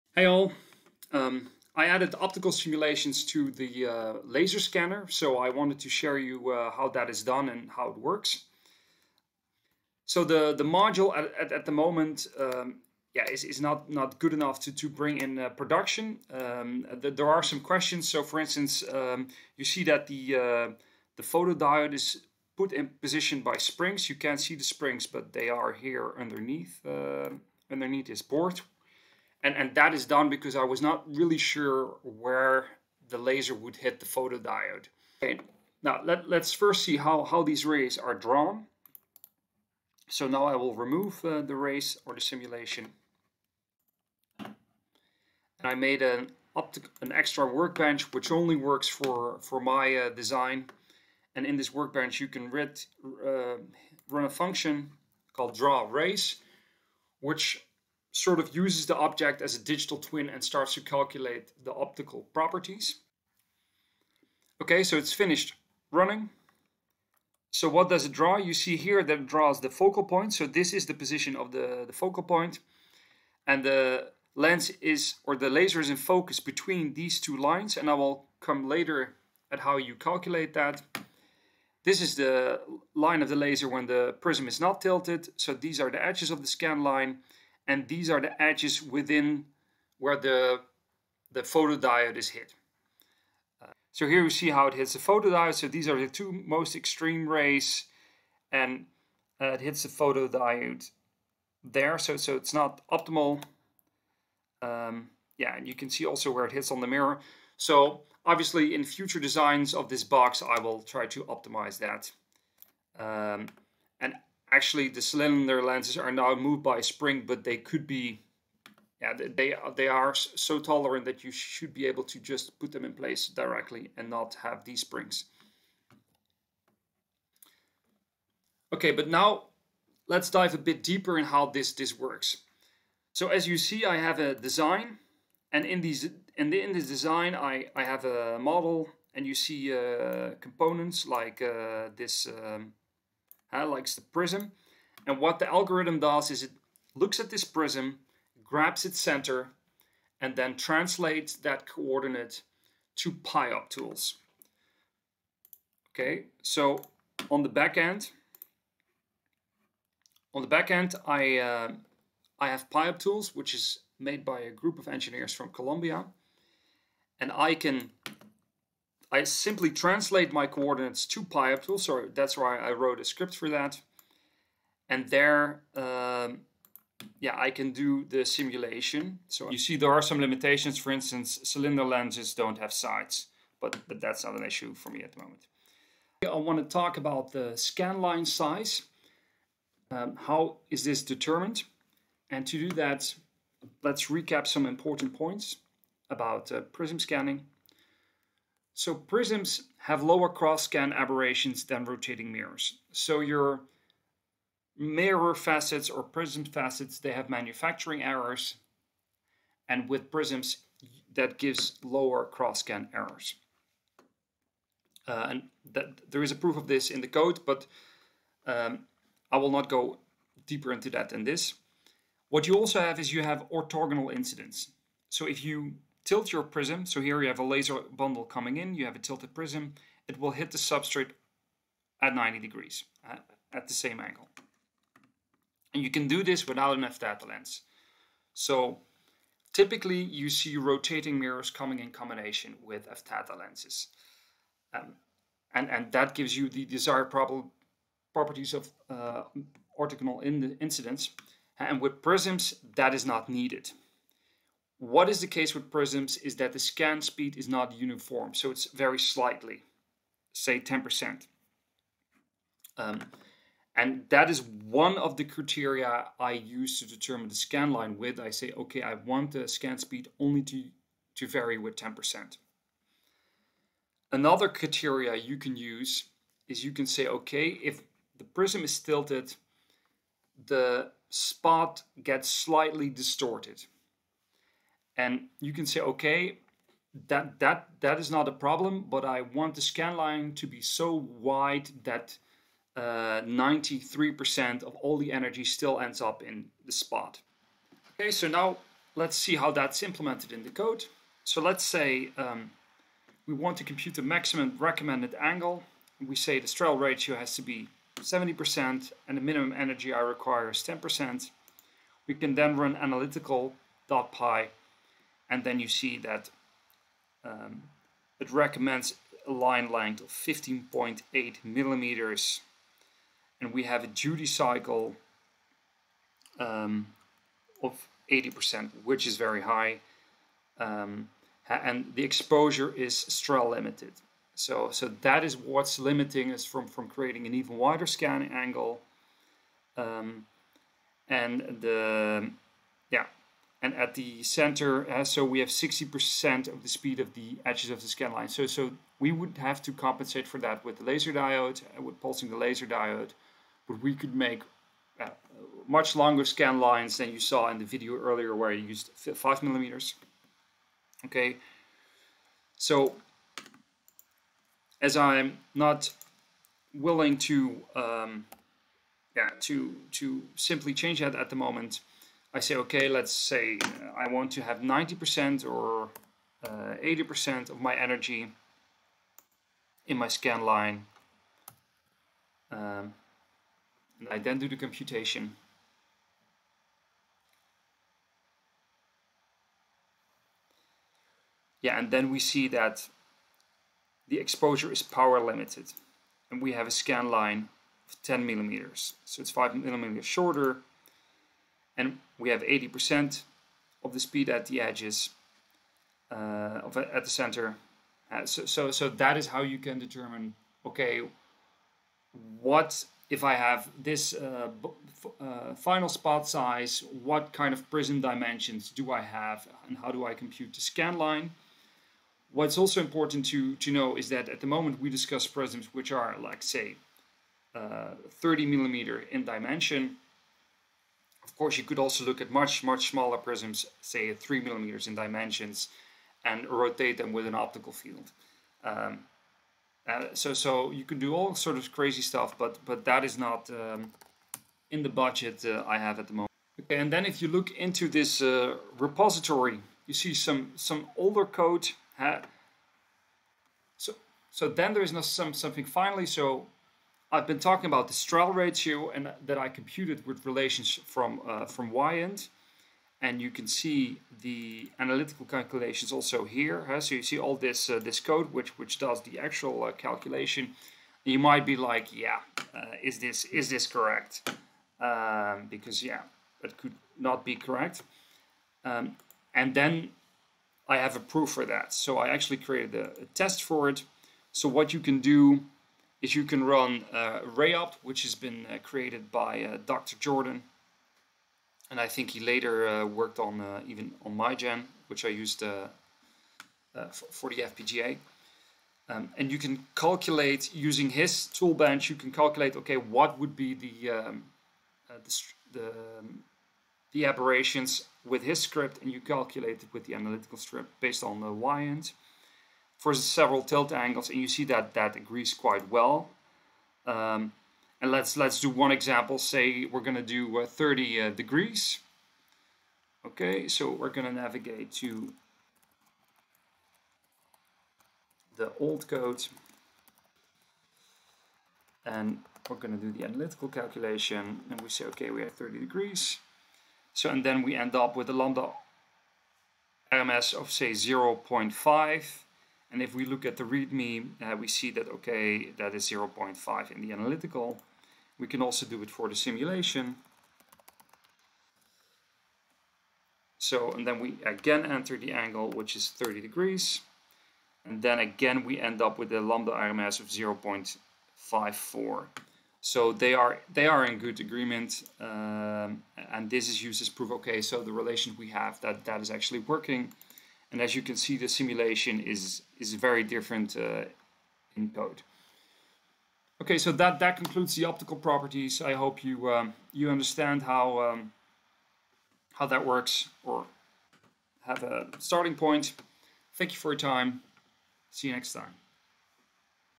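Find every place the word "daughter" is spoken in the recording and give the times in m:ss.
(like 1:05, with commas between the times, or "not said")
not said.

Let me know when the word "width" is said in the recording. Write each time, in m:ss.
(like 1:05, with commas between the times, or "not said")
4:27.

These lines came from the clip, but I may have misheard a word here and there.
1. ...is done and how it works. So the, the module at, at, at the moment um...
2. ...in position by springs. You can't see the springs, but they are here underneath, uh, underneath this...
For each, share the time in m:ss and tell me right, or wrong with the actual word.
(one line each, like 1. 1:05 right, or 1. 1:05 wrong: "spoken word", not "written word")
1. 0:07 right
2. 0:22 right.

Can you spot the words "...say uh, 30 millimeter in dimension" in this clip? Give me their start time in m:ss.
7:06.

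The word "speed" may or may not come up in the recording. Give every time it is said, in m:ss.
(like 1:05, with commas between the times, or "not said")
4:17, 4:29, 5:46, 6:43.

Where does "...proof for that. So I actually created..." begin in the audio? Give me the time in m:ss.
8:00.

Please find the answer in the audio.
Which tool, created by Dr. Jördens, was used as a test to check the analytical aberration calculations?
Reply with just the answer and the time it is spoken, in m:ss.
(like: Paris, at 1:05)
Rayopt, at 8:07.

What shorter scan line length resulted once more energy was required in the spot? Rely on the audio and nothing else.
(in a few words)
10 millimeters.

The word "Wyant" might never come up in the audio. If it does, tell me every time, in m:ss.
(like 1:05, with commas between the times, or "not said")
7:41, 8:31.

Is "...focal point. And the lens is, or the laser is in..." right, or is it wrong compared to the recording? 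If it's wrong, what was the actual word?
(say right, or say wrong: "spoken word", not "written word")
right.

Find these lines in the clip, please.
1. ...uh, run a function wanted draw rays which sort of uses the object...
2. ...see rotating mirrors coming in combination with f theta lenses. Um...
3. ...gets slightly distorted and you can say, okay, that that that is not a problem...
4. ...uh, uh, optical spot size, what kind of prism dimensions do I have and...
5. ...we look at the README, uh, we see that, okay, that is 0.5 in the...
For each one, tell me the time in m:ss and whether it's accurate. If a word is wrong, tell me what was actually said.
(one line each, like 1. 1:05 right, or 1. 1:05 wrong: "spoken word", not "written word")
1. 0:52 wrong: "called", not "wanted"
2. 4:00 right
3. 4:42 right
4. 6:54 wrong: "final", not "optical"
5. 9:02 right.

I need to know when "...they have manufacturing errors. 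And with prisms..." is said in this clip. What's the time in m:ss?
3:26.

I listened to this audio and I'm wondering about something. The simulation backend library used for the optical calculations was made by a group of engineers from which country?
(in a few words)
Colombia.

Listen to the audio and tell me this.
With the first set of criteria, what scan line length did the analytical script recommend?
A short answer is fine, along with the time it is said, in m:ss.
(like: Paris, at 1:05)
15.8 millimeters, at 5:20.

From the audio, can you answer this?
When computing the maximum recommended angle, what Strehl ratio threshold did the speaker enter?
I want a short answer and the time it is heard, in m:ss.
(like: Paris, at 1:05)
70%, at 5:07.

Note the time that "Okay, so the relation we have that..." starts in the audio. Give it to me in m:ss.
9:27.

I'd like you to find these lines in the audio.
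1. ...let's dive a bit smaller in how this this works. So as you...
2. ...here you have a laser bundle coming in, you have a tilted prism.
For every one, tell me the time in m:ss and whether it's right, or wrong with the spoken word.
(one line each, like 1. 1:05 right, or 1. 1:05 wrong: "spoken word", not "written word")
1. 2:10 wrong: "deeper", not "smaller"
2. 3:47 right.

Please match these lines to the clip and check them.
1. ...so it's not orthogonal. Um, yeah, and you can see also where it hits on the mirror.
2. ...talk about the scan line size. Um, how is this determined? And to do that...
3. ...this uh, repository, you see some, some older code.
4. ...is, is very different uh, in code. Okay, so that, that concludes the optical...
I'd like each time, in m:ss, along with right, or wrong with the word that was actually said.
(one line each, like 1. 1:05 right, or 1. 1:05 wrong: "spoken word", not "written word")
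1. 1:42 wrong: "optimal", not "orthogonal"
2. 3:06 right
3. 7:27 right
4. 9:31 right.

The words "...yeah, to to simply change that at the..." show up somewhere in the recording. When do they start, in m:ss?
6:09.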